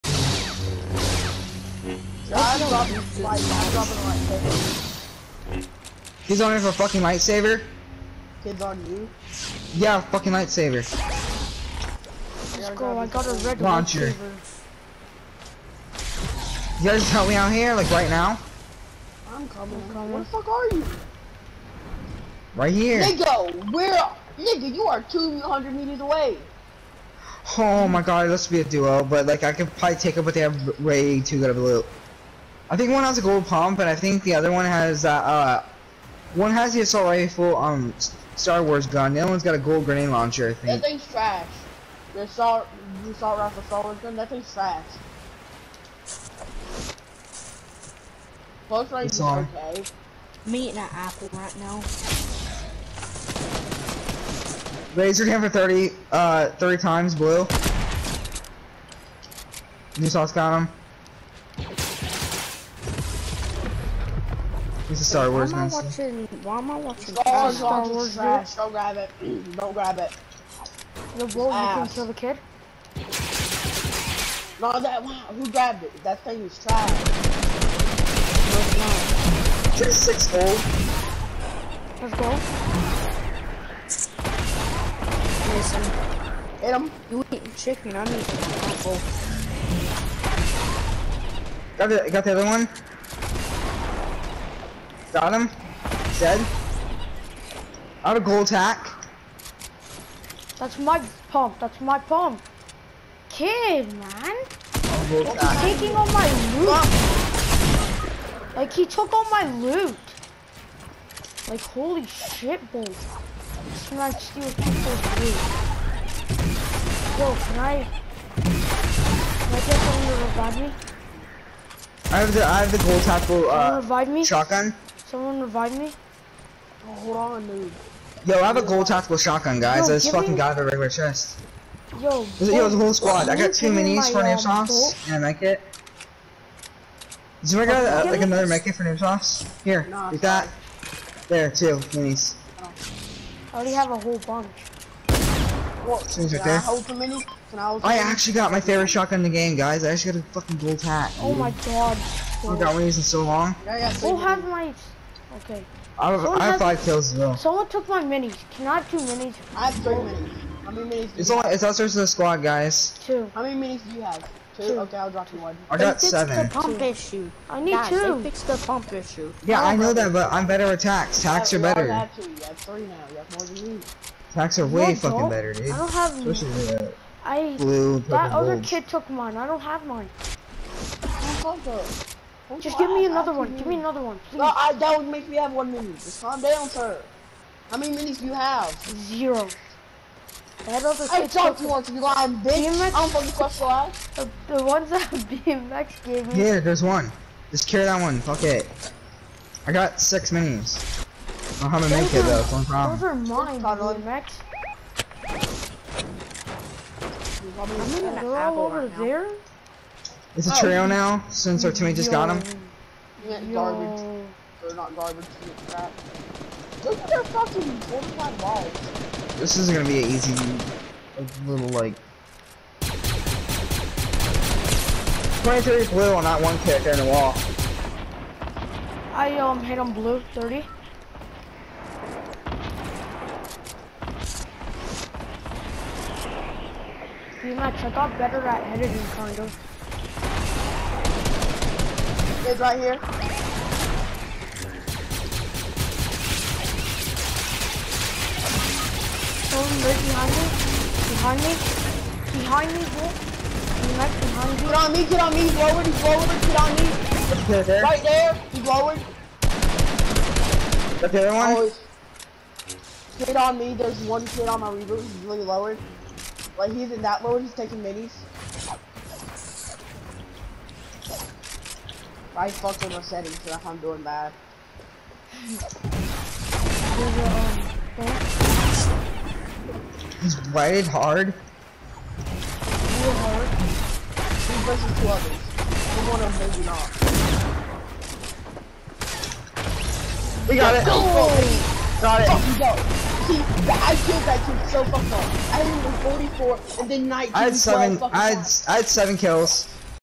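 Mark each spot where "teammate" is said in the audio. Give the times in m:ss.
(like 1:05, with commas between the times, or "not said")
3:31.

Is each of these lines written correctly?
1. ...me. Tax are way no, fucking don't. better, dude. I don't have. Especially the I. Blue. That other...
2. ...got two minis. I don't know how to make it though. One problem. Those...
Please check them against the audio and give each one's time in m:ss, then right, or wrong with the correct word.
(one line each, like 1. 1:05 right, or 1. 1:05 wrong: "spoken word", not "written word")
1. 2:53 right
2. 3:19 wrong: "six", not "two".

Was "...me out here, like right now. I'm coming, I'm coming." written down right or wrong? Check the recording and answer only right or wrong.
right.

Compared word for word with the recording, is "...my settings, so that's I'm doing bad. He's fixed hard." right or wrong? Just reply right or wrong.
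wrong.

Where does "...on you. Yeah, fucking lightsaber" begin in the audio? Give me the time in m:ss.
0:08.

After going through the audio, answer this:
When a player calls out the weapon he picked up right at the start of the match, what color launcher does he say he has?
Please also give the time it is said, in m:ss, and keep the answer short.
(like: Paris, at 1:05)
Red, at 0:13.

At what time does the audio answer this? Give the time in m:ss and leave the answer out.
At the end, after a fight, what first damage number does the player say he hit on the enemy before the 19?
4:56.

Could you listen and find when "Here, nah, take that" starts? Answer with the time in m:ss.
2:19.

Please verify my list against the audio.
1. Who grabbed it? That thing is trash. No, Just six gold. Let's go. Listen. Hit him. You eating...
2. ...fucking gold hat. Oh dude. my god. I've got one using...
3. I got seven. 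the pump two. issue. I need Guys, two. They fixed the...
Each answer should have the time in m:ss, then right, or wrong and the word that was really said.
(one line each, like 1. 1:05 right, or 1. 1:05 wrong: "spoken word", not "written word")
1. 1:15 right
2. 2:30 right
3. 2:45 right.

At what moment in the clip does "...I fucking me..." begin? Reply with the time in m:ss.
2:09.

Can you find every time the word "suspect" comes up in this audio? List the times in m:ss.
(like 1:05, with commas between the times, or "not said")
not said.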